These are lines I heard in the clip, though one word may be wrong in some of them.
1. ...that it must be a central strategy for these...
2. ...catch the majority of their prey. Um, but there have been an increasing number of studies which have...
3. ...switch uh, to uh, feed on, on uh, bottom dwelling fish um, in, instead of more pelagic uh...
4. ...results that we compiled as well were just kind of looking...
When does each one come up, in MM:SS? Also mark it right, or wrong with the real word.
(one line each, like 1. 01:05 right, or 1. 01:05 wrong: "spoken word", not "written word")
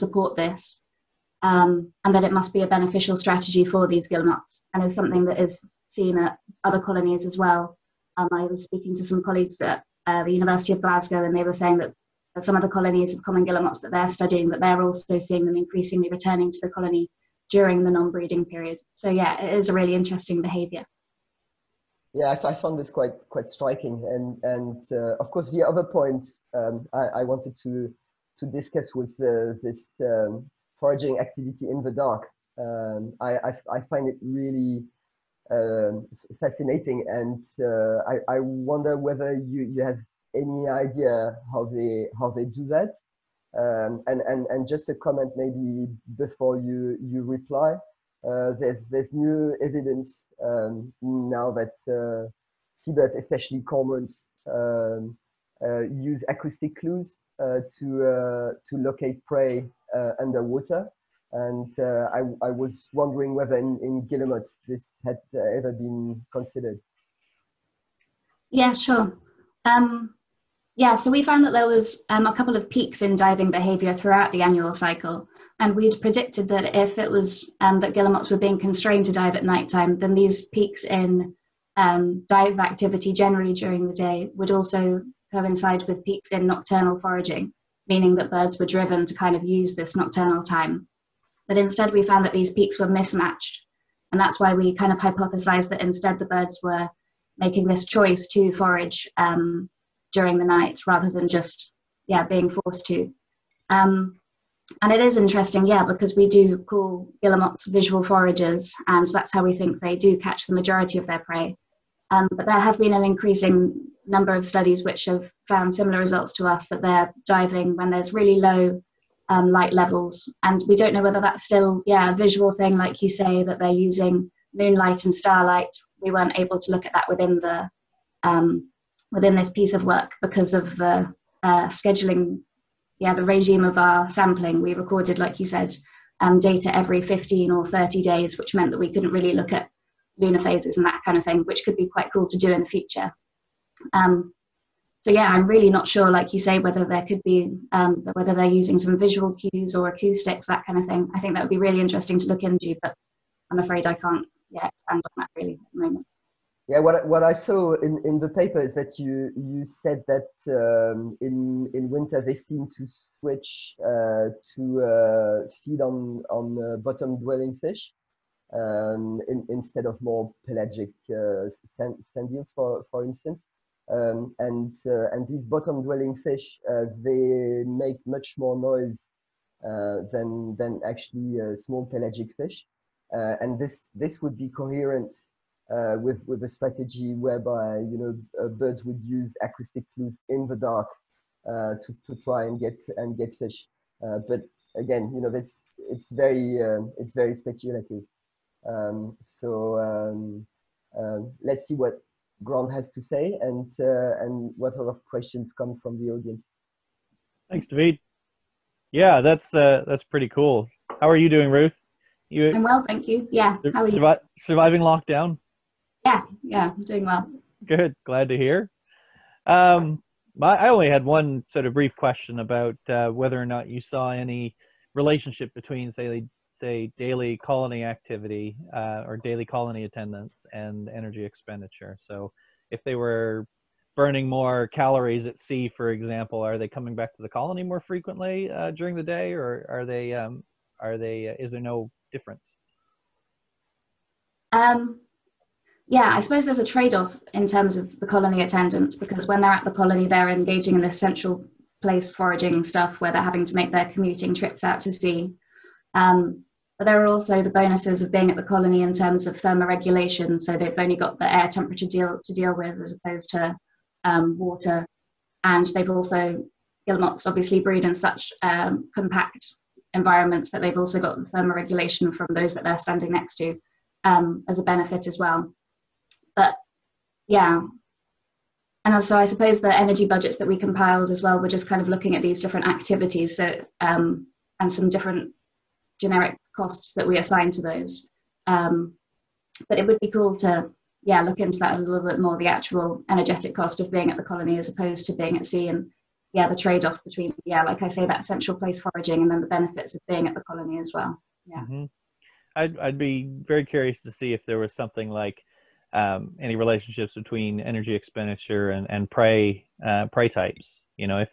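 1. 00:02 wrong: "beneficial", not "central"
2. 01:50 right
3. 02:43 right
4. 04:40 wrong: "budgets", not "results".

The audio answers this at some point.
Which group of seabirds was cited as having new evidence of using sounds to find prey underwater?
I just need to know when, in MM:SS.
00:53.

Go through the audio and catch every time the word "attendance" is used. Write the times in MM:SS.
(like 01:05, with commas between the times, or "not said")
03:49, 04:08.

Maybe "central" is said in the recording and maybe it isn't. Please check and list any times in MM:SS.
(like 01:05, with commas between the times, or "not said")
04:10, 04:58.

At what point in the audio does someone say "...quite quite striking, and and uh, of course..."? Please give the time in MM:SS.
00:22.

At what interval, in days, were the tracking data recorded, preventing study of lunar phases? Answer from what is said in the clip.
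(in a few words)
15 or 30 days.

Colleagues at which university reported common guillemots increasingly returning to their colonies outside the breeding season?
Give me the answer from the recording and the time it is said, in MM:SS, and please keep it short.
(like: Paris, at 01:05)
University of Glasgow, at 00:10.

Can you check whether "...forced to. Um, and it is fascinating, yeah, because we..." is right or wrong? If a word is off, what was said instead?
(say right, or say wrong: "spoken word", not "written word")
wrong: "interesting", not "fascinating".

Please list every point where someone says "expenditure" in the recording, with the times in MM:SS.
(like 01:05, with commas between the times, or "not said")
03:51, 05:07.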